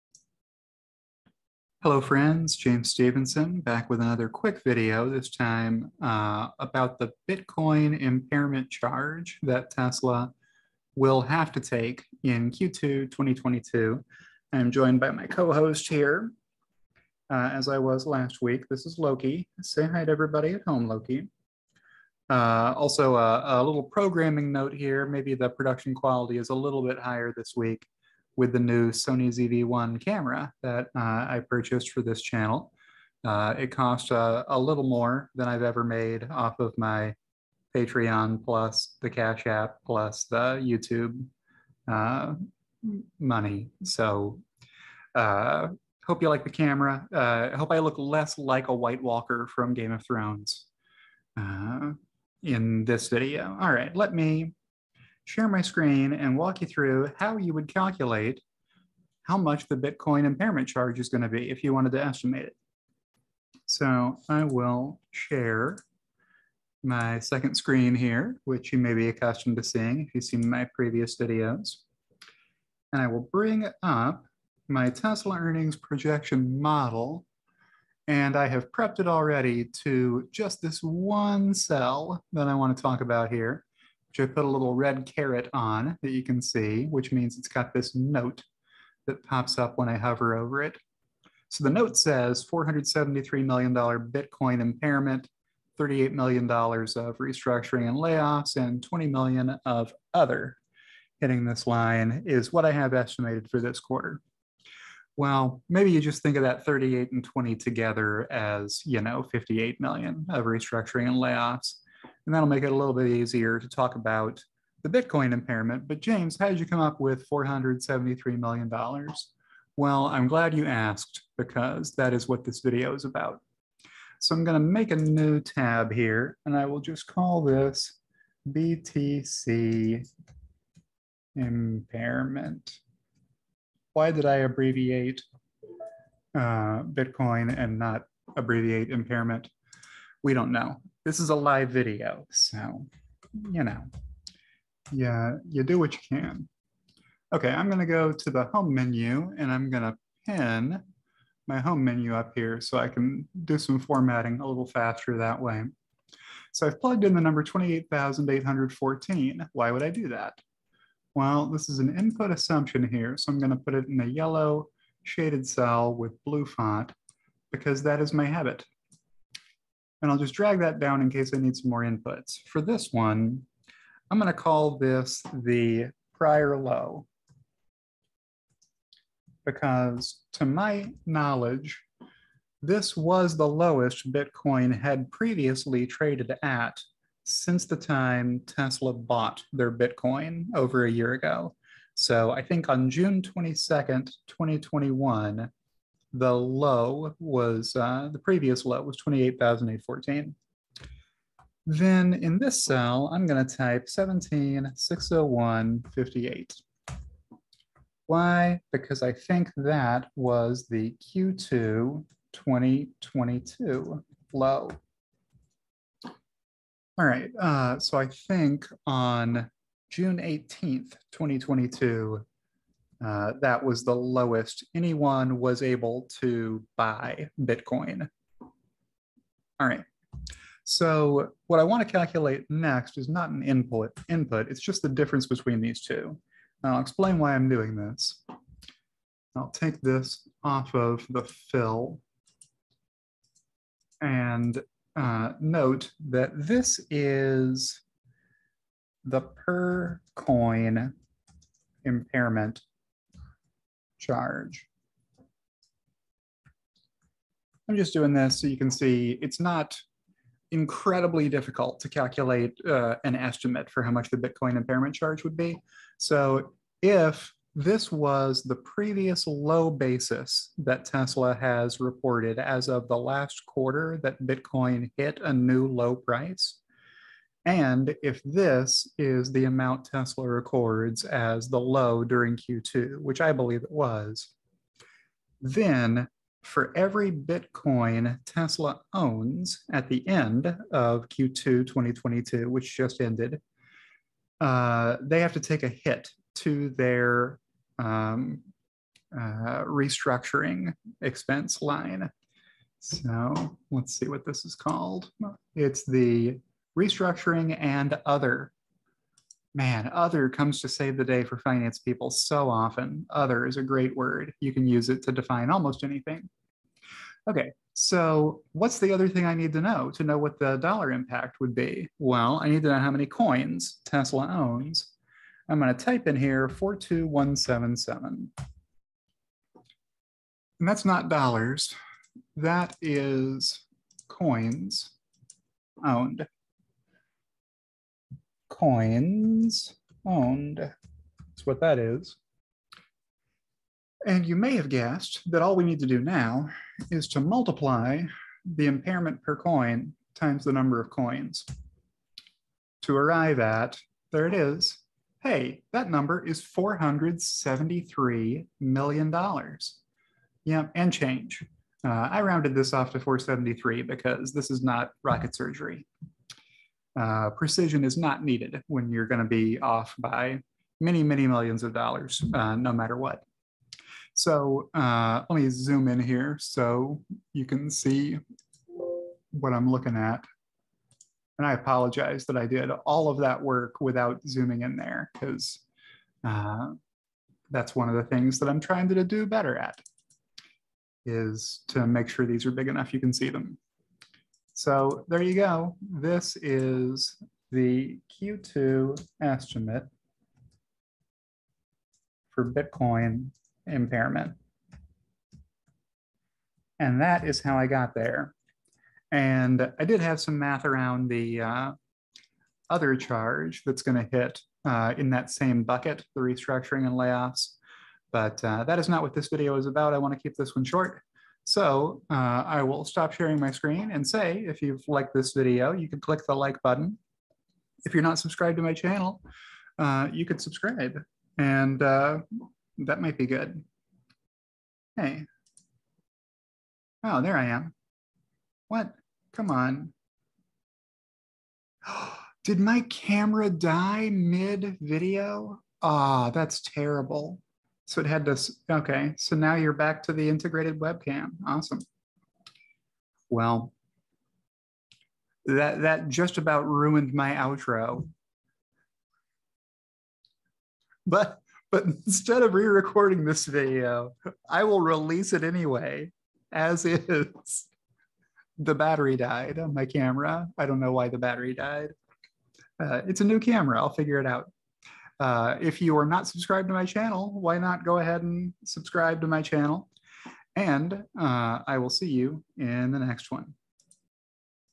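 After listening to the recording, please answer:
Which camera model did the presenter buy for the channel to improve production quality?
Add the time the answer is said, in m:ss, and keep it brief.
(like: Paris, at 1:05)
Sony ZV-1, at 0:28.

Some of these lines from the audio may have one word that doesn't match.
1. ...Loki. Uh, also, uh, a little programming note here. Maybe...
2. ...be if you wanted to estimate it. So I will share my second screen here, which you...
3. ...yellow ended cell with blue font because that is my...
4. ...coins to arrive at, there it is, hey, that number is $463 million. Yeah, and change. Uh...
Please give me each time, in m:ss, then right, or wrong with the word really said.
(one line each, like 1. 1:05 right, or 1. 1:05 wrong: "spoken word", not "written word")
1. 0:20 right
2. 1:01 right
3. 2:44 wrong: "shaded", not "ended"
4. 5:50 wrong: "473", not "463".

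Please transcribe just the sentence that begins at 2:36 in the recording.
So I've plugged in the number 28,814.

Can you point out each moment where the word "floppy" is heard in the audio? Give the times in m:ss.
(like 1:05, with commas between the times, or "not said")
not said.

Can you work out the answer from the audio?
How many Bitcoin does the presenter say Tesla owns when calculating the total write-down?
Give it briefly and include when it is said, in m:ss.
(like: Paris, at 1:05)
42,177, at 5:26.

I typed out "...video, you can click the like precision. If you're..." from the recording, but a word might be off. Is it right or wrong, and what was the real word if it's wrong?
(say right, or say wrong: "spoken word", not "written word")
wrong: "button", not "precision".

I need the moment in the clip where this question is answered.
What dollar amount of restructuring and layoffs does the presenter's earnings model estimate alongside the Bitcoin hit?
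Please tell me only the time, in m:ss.
1:35.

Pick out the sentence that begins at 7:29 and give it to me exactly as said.
So now you're back to the integrated webcam.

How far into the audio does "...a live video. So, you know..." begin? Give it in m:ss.
2:21.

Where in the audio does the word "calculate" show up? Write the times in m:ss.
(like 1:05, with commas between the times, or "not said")
0:57, 3:51, 4:21.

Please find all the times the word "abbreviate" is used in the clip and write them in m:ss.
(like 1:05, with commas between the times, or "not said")
2:14, 2:18.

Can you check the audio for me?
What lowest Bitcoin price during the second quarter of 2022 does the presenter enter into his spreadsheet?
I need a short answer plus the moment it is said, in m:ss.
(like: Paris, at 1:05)
17,601.58, at 3:23.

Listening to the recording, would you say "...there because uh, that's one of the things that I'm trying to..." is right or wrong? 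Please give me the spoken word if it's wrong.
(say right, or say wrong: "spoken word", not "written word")
right.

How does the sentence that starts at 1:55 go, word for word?
But James, how did you come up with $473 million?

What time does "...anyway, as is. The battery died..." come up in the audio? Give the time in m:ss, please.
7:45.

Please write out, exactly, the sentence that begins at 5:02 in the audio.
So let's see what this is called.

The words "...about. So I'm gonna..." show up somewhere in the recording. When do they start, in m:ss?
2:03.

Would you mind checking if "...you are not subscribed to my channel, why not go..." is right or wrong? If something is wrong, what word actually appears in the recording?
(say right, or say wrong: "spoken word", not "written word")
right.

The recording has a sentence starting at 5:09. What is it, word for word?
Man, other comes to save the day for finance people so often.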